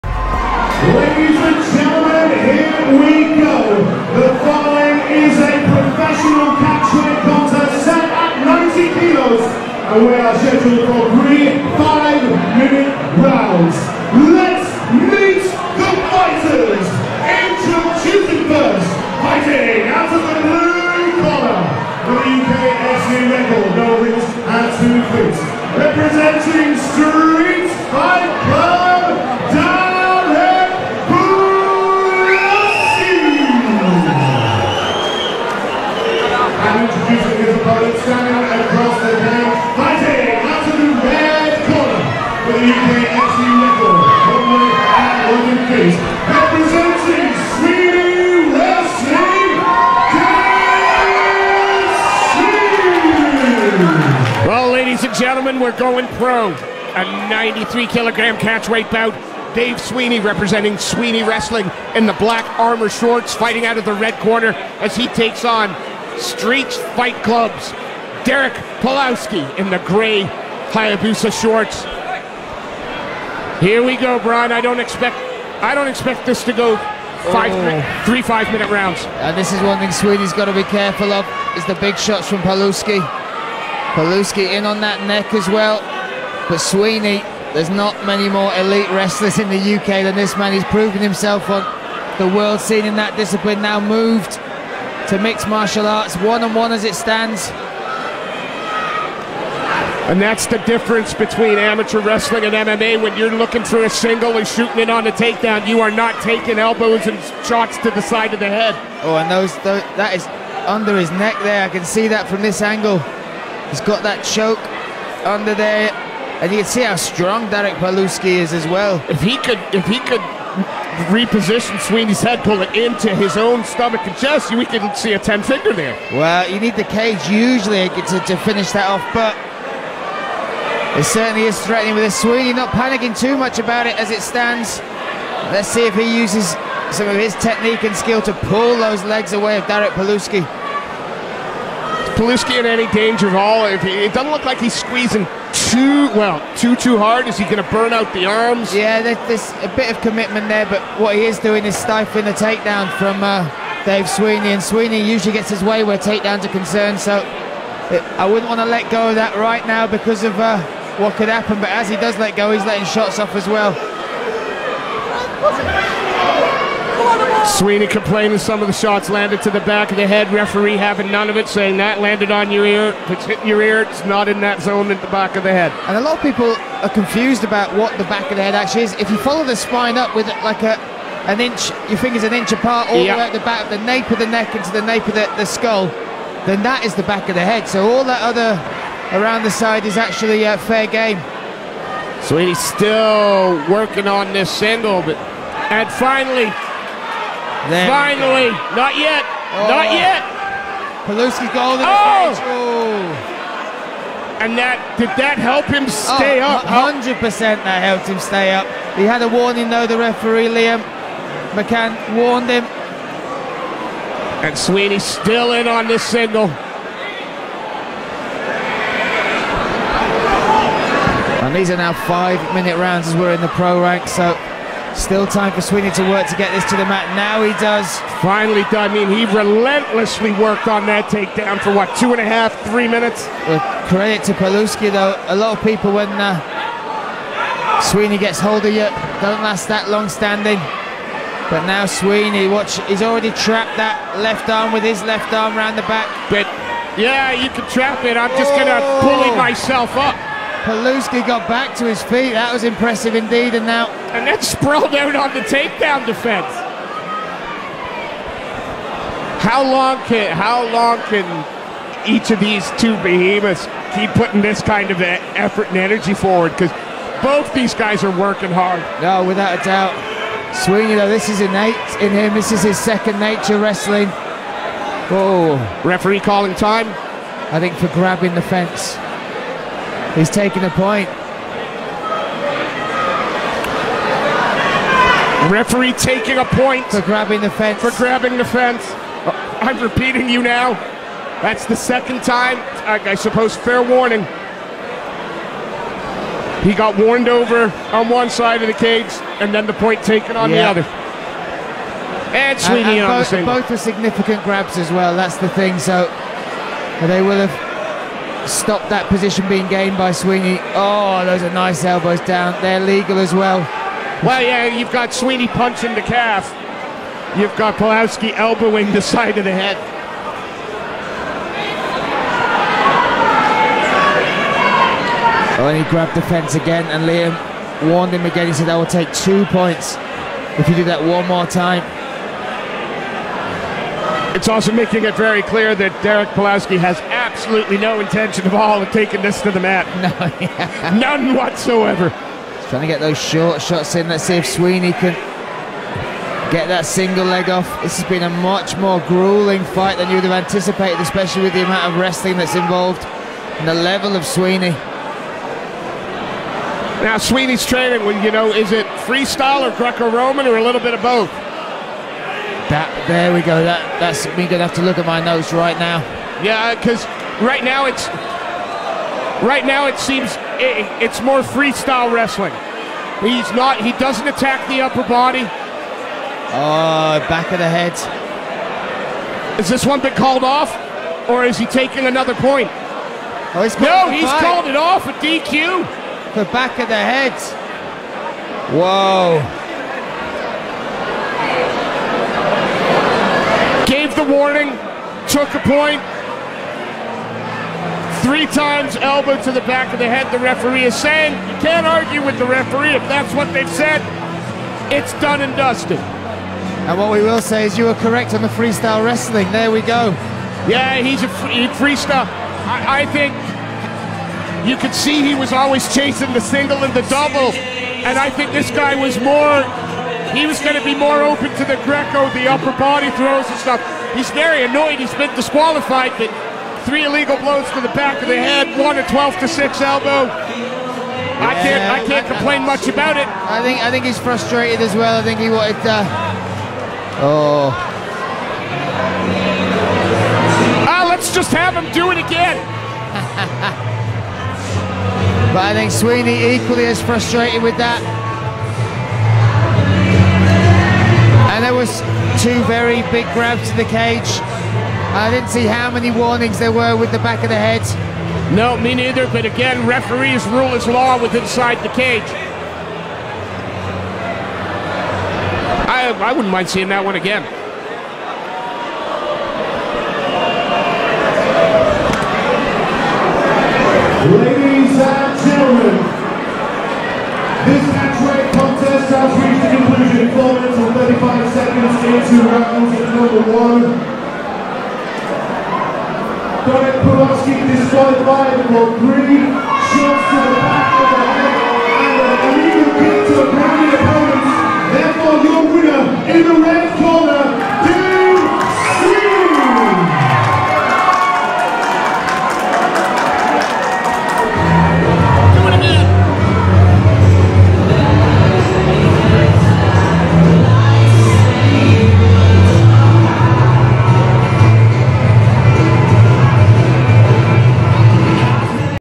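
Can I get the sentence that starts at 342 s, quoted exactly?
trying to get those short shots in.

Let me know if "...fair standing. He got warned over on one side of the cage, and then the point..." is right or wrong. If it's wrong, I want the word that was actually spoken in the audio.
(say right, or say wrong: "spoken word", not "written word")
wrong: "warning", not "standing".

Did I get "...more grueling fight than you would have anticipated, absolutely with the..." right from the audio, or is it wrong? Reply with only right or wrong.
wrong.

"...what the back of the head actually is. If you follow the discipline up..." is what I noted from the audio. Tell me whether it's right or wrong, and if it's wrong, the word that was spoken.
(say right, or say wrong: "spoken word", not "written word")
wrong: "spine", not "discipline".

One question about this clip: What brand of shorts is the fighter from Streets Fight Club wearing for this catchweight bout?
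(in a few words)
Hayabusa.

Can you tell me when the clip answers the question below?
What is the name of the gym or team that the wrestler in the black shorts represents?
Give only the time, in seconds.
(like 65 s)
60 s.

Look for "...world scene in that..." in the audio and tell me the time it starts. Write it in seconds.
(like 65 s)
92 s.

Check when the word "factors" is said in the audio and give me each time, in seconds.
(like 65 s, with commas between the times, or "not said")
not said.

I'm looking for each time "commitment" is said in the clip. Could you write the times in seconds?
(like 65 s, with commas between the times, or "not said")
150 s.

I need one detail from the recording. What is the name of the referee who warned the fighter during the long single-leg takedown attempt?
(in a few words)
Liam McCann.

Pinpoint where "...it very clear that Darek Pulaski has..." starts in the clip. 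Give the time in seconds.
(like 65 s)
335 s.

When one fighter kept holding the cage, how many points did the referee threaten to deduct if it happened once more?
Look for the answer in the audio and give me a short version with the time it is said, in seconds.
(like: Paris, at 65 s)
2, at 329 s.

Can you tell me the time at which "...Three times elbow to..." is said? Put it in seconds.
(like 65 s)
398 s.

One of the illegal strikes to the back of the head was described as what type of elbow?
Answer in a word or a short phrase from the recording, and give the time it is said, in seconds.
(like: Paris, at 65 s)
12 to 6 elbow, at 429 s.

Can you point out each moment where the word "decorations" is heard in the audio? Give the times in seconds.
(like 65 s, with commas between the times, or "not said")
not said.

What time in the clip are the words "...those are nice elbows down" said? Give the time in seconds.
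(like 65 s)
311 s.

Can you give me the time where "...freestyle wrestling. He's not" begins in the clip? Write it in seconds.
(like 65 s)
371 s.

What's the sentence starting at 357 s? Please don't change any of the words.
Now, Sweeney's training, well, you know, is it freestyle or Greco-Roman or a little bit of both?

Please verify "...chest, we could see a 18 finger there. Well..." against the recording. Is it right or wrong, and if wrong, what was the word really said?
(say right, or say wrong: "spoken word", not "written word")
wrong: "10", not "18".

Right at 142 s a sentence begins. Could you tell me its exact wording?
Pulaski in any danger at all?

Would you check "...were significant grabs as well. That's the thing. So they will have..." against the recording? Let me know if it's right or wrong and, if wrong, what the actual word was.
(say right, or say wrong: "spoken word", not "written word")
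right.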